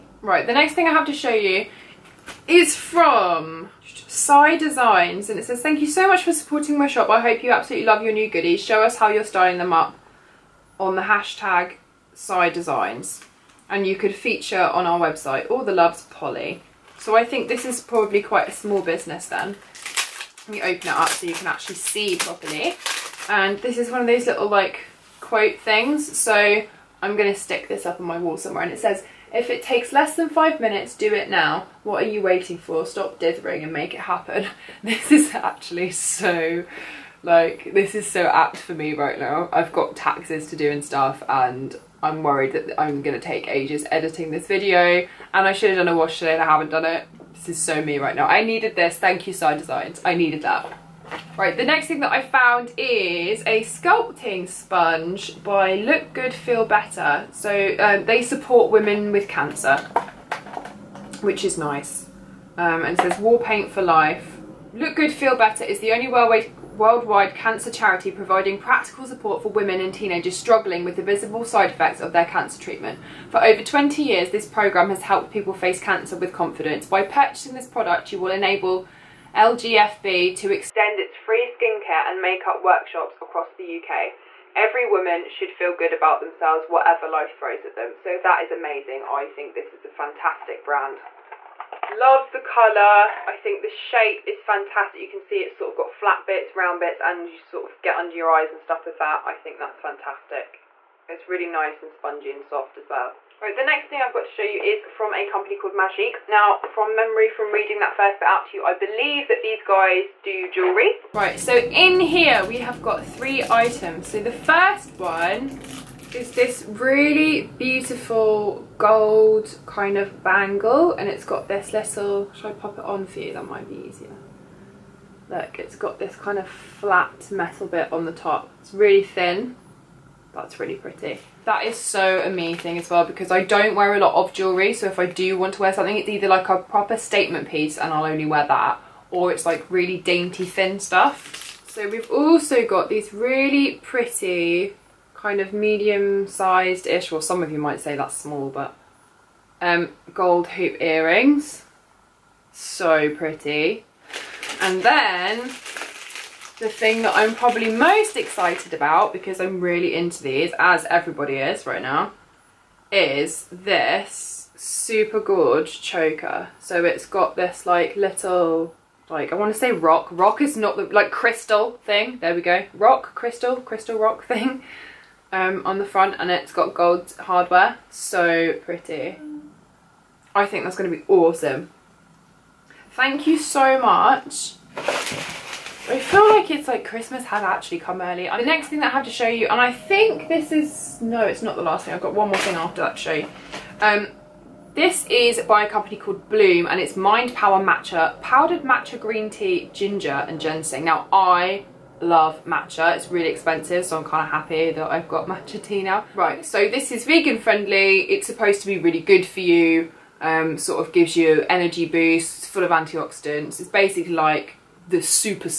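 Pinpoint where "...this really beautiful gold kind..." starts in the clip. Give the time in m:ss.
1:56.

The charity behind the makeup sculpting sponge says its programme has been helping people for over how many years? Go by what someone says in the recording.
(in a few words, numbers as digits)
20 years.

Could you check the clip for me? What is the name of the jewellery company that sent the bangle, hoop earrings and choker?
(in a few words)
Majique.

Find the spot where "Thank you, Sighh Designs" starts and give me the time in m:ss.
0:48.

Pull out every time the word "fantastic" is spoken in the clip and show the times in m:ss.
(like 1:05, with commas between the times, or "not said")
1:29, 1:34, 1:39.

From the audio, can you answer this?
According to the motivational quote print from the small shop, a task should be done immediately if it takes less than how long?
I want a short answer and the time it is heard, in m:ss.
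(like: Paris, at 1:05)
5 minutes, at 0:30.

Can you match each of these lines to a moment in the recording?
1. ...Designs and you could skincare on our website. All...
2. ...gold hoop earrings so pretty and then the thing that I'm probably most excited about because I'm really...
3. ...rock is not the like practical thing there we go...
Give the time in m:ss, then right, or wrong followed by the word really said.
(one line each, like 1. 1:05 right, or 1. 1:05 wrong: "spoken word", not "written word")
1. 0:12 wrong: "feature", not "skincare"
2. 2:30 right
3. 2:50 wrong: "crystal", not "practical".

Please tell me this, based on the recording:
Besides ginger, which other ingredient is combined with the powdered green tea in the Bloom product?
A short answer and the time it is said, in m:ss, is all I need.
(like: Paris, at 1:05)
Ginseng, at 3:20.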